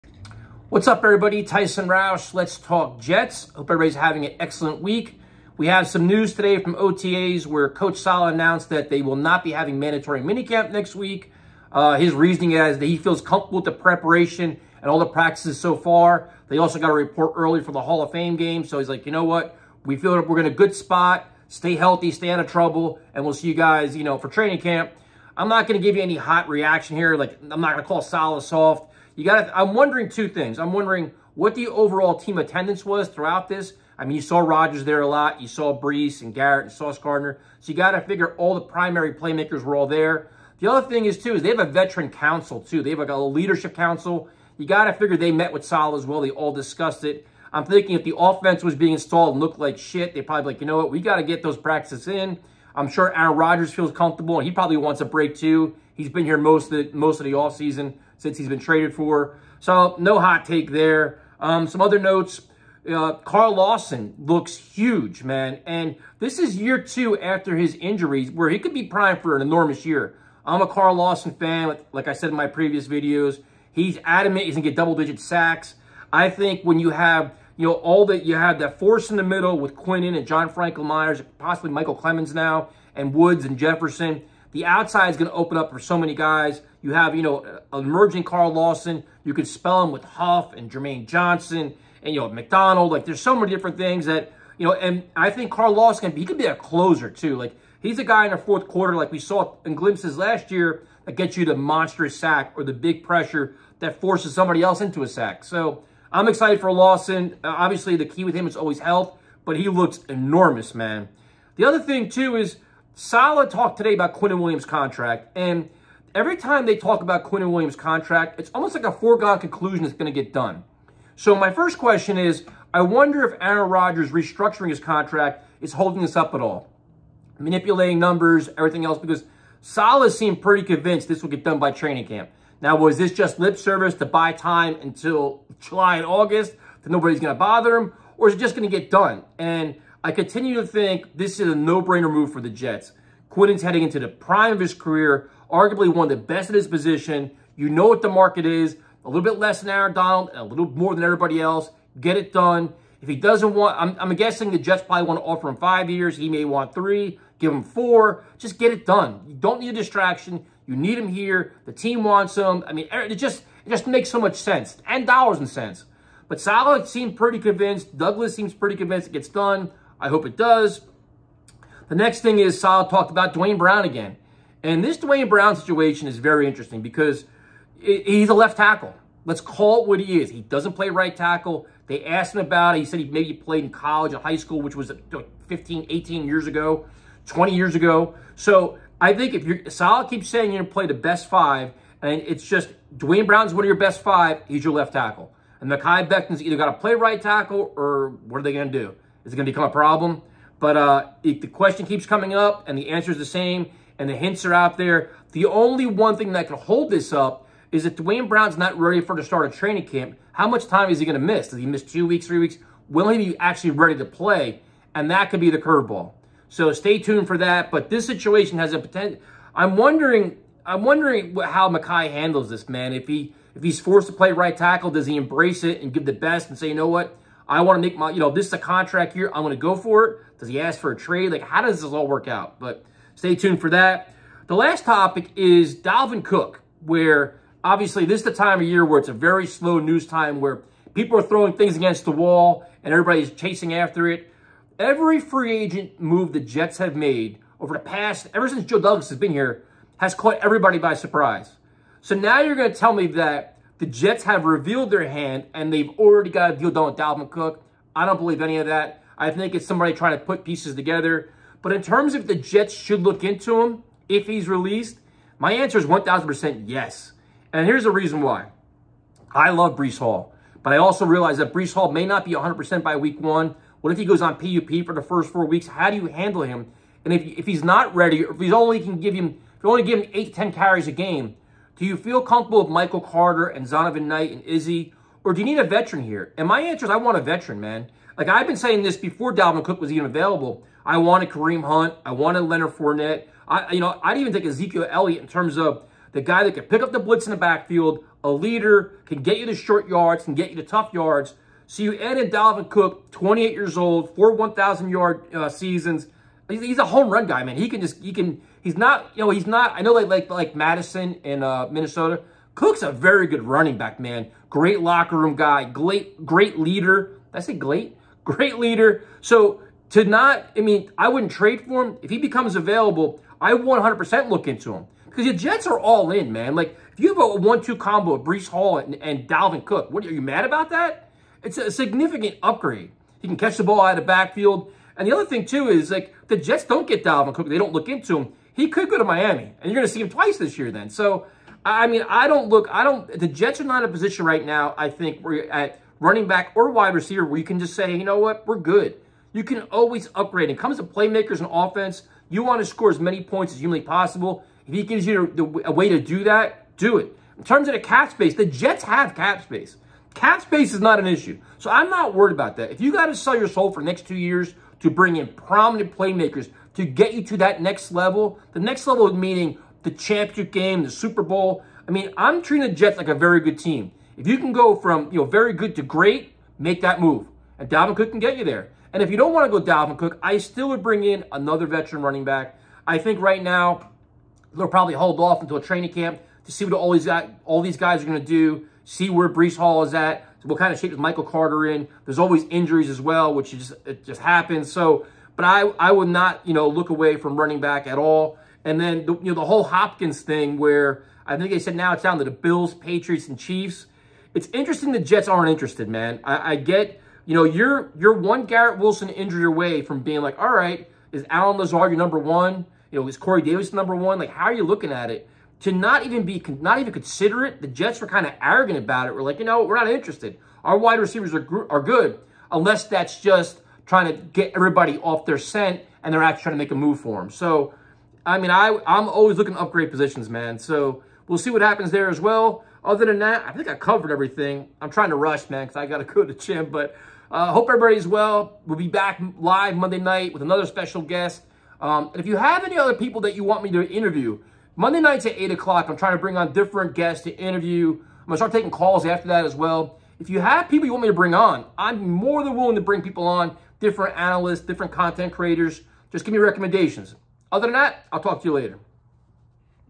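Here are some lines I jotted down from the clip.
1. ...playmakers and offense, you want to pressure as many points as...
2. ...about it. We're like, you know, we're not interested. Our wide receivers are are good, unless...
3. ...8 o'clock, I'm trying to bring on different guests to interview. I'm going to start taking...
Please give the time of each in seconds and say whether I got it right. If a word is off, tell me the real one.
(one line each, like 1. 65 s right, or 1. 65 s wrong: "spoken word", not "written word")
1. 350 s wrong: "score", not "pressure"
2. 418 s right
3. 445 s right.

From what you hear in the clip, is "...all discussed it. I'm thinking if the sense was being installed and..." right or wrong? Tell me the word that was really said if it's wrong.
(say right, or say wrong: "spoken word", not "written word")
wrong: "offense", not "sense".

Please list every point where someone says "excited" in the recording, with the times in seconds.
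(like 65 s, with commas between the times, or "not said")
106 s.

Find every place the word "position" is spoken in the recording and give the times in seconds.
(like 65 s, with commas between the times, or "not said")
146 s, 343 s, 429 s.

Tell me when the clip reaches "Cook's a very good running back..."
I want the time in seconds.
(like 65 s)
312 s.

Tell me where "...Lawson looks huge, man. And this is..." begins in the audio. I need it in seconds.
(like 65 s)
63 s.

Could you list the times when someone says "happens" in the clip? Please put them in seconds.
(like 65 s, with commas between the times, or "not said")
394 s, 431 s.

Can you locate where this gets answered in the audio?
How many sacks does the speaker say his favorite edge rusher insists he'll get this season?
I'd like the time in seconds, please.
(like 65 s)
74 s.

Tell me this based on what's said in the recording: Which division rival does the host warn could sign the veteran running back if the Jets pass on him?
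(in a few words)
Miami.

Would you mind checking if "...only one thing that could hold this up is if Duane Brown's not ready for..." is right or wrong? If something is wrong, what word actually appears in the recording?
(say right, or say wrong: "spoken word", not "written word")
right.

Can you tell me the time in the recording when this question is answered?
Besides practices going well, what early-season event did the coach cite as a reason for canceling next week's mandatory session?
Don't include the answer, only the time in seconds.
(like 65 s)
17 s.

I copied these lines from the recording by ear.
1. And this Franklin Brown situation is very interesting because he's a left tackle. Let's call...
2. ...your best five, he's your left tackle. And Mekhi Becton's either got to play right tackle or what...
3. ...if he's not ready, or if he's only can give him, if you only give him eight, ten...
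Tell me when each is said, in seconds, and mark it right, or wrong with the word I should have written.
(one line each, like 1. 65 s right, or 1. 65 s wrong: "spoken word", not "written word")
1. 174 s wrong: "Duane", not "Franklin"
2. 193 s right
3. 277 s right.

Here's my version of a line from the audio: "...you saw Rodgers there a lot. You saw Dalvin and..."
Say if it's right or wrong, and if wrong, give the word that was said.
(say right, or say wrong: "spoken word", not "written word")
wrong: "Breece", not "Dalvin".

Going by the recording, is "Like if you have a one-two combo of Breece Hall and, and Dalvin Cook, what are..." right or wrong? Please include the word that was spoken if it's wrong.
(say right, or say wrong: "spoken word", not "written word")
right.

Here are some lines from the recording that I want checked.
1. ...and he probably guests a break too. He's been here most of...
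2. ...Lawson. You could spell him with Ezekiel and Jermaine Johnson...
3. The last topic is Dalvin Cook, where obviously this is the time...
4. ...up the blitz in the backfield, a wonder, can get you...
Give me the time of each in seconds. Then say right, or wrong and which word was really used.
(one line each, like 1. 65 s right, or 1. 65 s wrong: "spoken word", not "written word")
1. 54 s wrong: "wants", not "guests"
2. 88 s wrong: "Huff", not "Ezekiel"
3. 234 s right
4. 296 s wrong: "leader", not "wonder".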